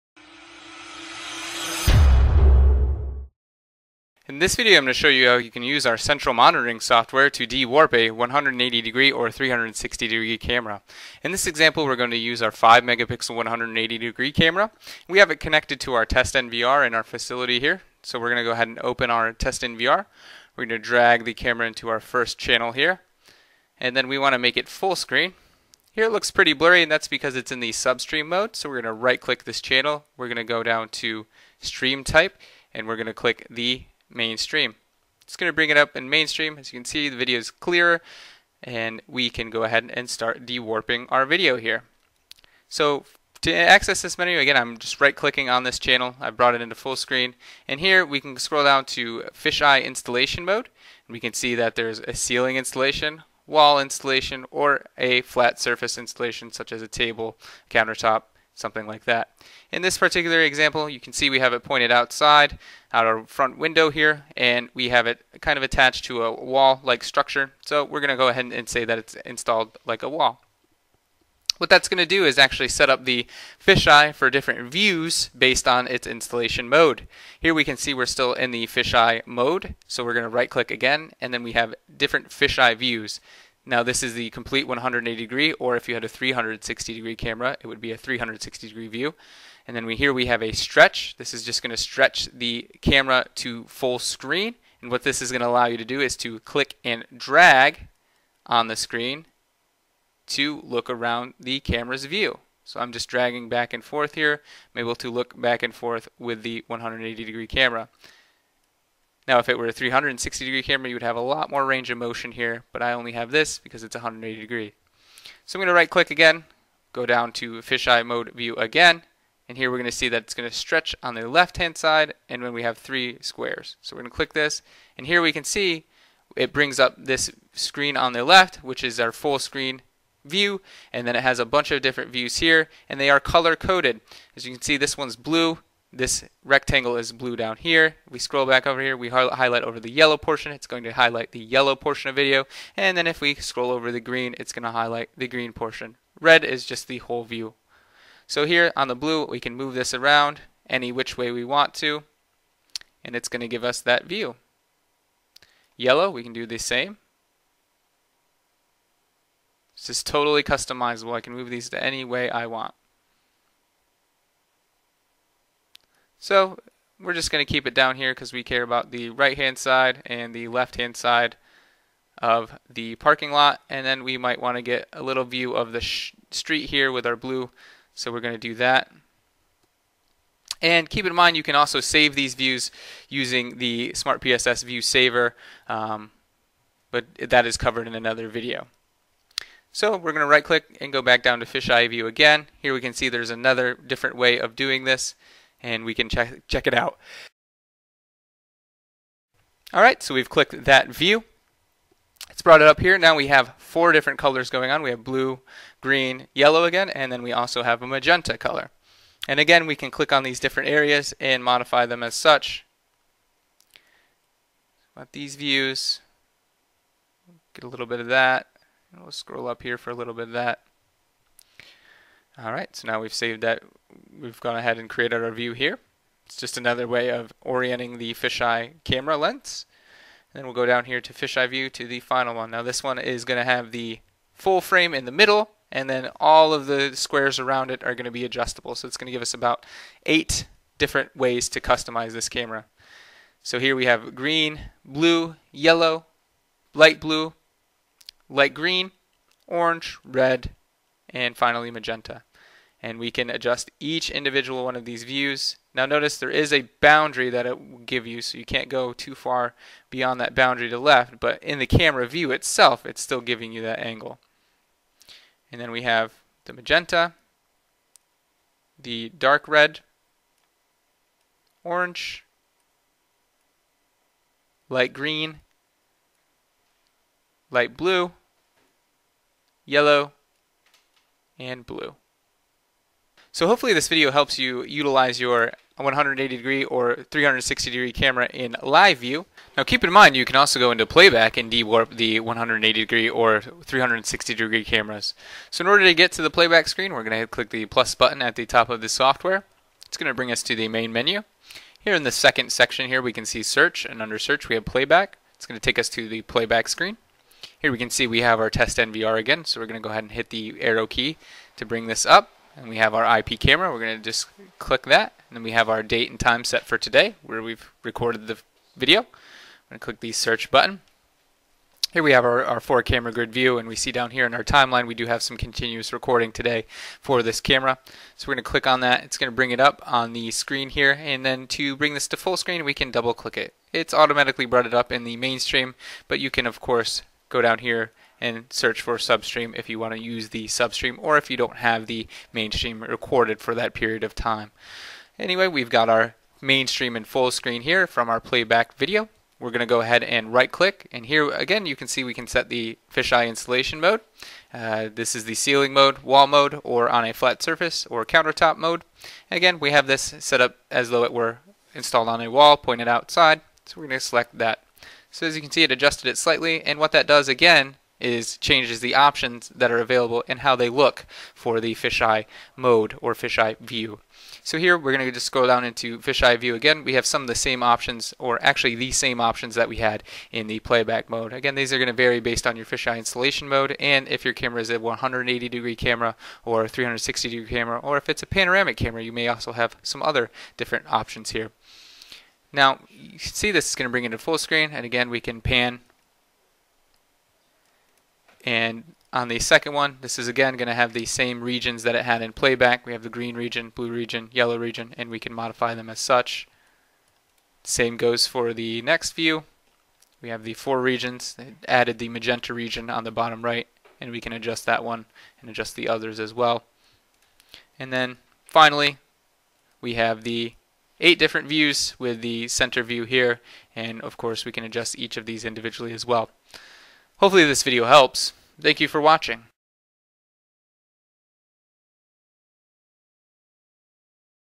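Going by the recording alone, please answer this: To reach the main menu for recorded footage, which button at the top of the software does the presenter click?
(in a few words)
Plus button.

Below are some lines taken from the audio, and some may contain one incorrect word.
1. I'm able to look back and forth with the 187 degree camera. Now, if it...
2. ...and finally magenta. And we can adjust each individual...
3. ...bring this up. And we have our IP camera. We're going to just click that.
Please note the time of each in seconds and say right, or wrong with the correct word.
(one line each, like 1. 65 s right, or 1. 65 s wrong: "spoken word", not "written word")
1. 104 s wrong: "180", not "187"
2. 251 s right
3. 311 s right.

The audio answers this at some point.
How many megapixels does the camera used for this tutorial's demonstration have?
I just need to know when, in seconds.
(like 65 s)
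12 s.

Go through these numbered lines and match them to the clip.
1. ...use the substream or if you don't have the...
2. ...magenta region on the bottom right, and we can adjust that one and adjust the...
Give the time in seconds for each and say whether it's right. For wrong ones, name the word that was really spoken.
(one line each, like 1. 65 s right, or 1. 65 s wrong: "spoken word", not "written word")
1. 340 s right
2. 412 s right.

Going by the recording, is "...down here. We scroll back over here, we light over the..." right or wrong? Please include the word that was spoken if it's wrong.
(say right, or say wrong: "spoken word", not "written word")
wrong: "highlight", not "light".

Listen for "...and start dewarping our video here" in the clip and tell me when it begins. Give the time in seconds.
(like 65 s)
39 s.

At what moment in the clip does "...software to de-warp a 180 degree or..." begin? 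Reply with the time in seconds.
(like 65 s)
6 s.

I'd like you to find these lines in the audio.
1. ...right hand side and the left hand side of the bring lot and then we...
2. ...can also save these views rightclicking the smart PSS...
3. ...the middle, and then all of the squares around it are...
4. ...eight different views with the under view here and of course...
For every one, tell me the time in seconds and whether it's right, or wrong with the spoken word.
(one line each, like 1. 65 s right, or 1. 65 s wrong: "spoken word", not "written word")
1. 169 s wrong: "parking", not "bring"
2. 181 s wrong: "using", not "rightclicking"
3. 235 s right
4. 421 s wrong: "center", not "under".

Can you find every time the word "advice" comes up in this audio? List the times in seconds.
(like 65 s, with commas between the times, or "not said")
not said.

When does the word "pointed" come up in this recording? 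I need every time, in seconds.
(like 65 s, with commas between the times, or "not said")
61 s, 362 s.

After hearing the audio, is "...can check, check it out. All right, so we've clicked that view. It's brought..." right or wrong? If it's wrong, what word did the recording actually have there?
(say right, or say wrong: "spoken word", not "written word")
right.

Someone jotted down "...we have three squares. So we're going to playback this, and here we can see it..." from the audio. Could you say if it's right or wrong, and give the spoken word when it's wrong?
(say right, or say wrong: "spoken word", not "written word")
wrong: "click", not "playback".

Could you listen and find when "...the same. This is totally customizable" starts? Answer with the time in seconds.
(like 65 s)
156 s.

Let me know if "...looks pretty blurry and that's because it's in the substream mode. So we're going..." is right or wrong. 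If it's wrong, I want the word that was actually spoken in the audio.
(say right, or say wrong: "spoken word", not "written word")
right.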